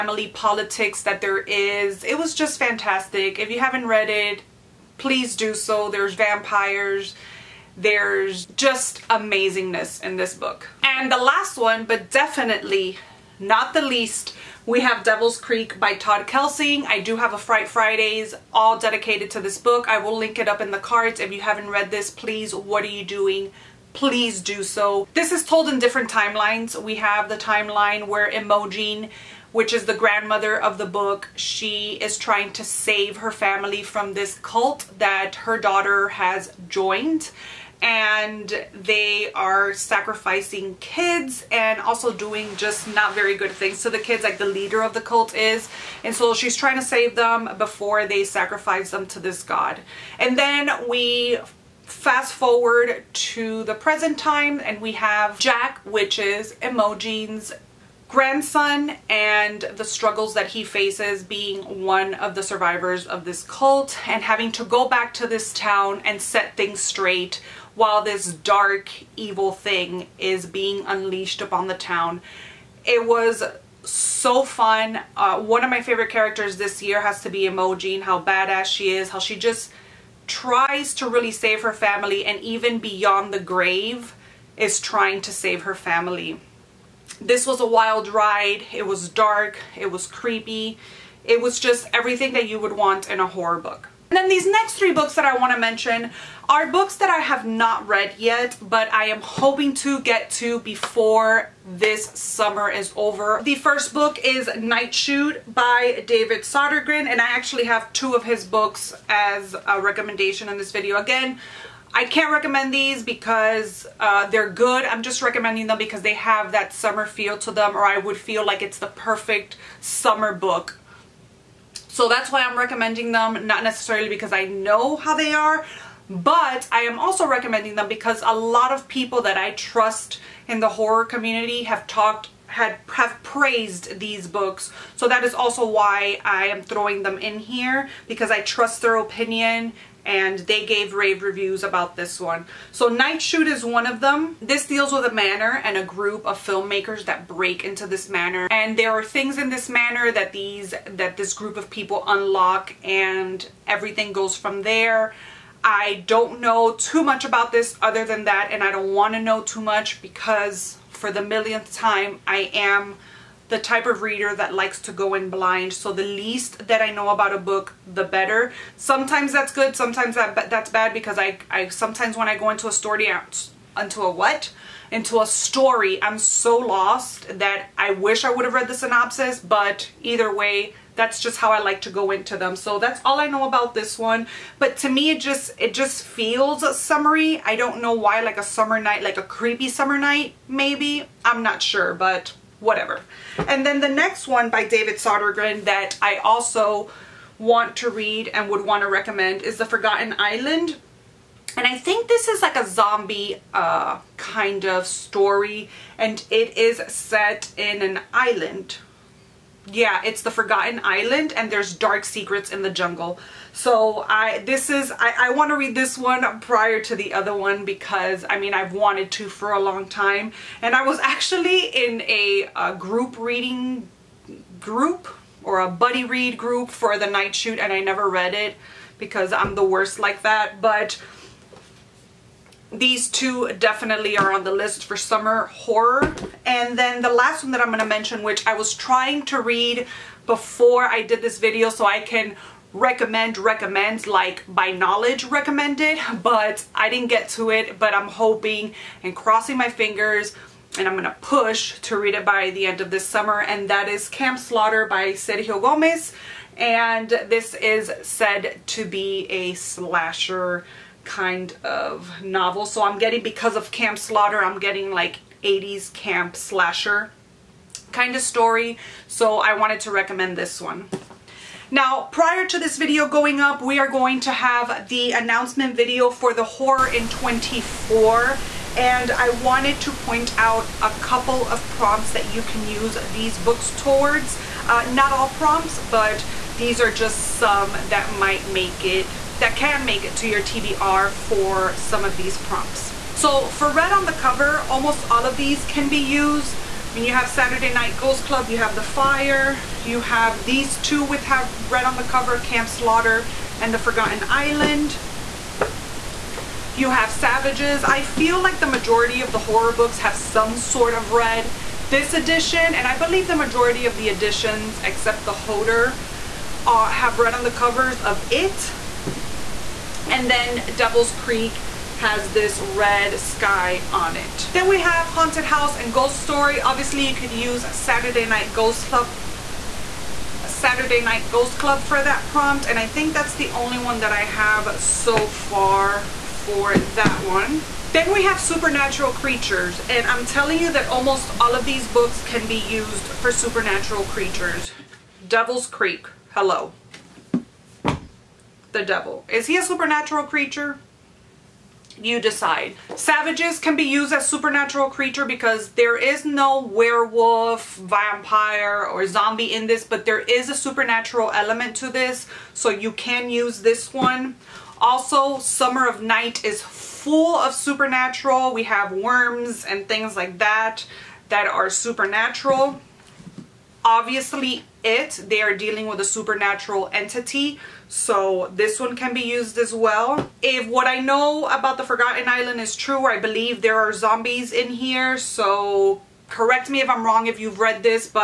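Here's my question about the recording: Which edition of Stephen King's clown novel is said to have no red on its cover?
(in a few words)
Hodder.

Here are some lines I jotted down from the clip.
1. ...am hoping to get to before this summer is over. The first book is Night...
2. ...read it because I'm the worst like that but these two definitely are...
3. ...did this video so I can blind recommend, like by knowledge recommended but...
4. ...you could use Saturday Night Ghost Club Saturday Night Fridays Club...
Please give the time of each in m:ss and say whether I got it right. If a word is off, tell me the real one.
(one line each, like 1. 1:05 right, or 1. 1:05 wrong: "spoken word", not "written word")
1. 1:39 right
2. 3:48 right
3. 4:01 wrong: "recommend", not "blind"
4. 5:27 wrong: "Ghost", not "Fridays".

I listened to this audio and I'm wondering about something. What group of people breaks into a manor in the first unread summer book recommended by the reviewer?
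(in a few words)
filmmakers.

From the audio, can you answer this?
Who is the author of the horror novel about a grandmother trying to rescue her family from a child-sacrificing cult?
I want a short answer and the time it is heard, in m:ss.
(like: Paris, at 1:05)
Todd Keisling, at 0:15.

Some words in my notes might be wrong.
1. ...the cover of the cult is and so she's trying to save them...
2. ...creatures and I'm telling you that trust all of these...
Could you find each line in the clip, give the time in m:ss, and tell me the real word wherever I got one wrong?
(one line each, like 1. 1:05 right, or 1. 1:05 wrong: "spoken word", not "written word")
1. 0:44 wrong: "leader", not "cover"
2. 5:39 wrong: "almost", not "trust".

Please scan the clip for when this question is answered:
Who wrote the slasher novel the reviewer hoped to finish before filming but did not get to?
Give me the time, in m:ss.
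4:15.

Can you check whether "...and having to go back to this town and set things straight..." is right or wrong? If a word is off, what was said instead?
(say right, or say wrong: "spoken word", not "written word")
right.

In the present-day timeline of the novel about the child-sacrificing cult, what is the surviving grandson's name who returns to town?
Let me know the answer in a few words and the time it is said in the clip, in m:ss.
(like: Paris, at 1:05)
Jack, at 0:55.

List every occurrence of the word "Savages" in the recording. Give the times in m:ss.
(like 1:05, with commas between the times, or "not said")
5:07, 5:52.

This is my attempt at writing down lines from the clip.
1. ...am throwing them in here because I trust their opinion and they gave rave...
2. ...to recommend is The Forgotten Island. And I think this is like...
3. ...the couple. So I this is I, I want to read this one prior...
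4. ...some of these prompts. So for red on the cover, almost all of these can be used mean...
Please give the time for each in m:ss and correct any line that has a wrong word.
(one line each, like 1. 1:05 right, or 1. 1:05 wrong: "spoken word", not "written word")
1. 2:16 right
2. 3:18 right
3. 3:32 wrong: "jungle", not "couple"
4. 4:51 right.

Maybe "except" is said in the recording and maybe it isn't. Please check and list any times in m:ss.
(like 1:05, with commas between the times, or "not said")
5:14.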